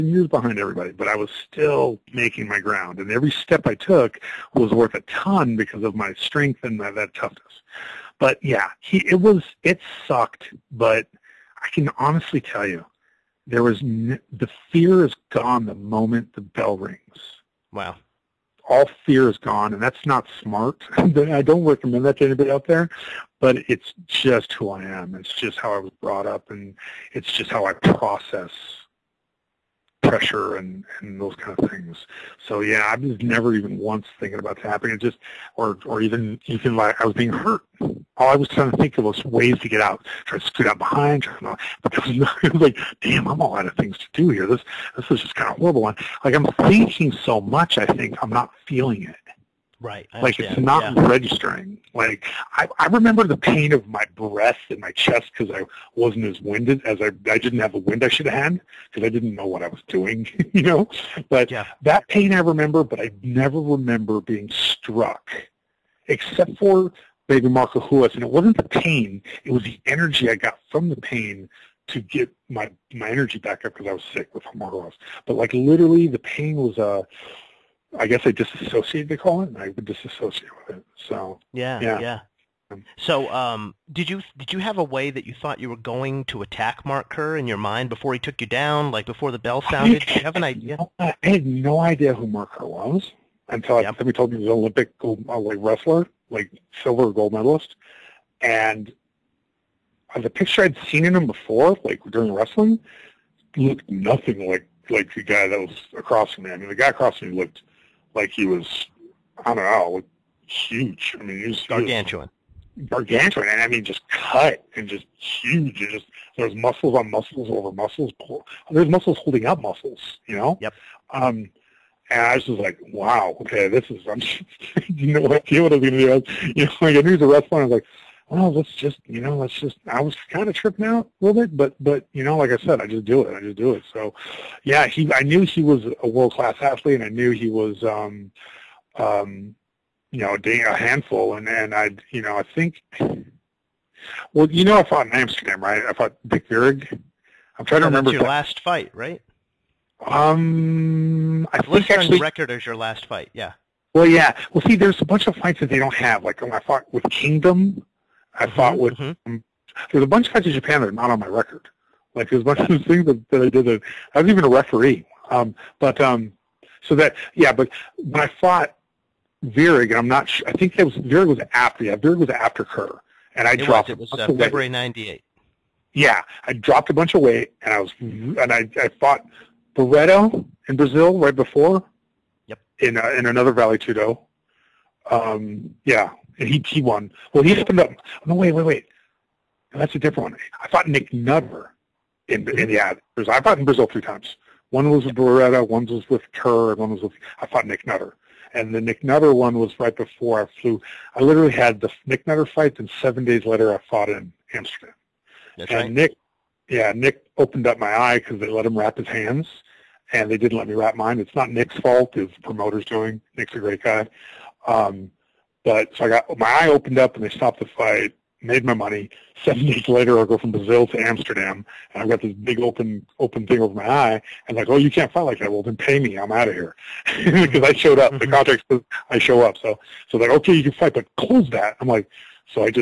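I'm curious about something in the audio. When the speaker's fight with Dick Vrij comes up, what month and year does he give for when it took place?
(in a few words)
February 1998.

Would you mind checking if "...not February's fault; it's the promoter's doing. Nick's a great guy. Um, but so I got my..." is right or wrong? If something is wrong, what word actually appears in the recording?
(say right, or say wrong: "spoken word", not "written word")
wrong: "Nick", not "February".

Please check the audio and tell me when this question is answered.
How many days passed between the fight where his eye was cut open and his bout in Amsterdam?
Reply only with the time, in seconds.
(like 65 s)
203 s.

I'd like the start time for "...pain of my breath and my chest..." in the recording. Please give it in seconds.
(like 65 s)
53 s.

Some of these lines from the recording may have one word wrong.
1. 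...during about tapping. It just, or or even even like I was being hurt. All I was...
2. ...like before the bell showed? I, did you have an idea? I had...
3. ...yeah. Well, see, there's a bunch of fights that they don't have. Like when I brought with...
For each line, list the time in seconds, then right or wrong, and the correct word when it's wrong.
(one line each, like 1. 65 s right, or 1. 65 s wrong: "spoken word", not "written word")
1. 34 s wrong: "thinking", not "during"
2. 88 s wrong: "sounded", not "showed"
3. 154 s wrong: "fought", not "brought".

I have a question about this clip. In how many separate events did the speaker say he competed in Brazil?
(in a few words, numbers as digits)
3.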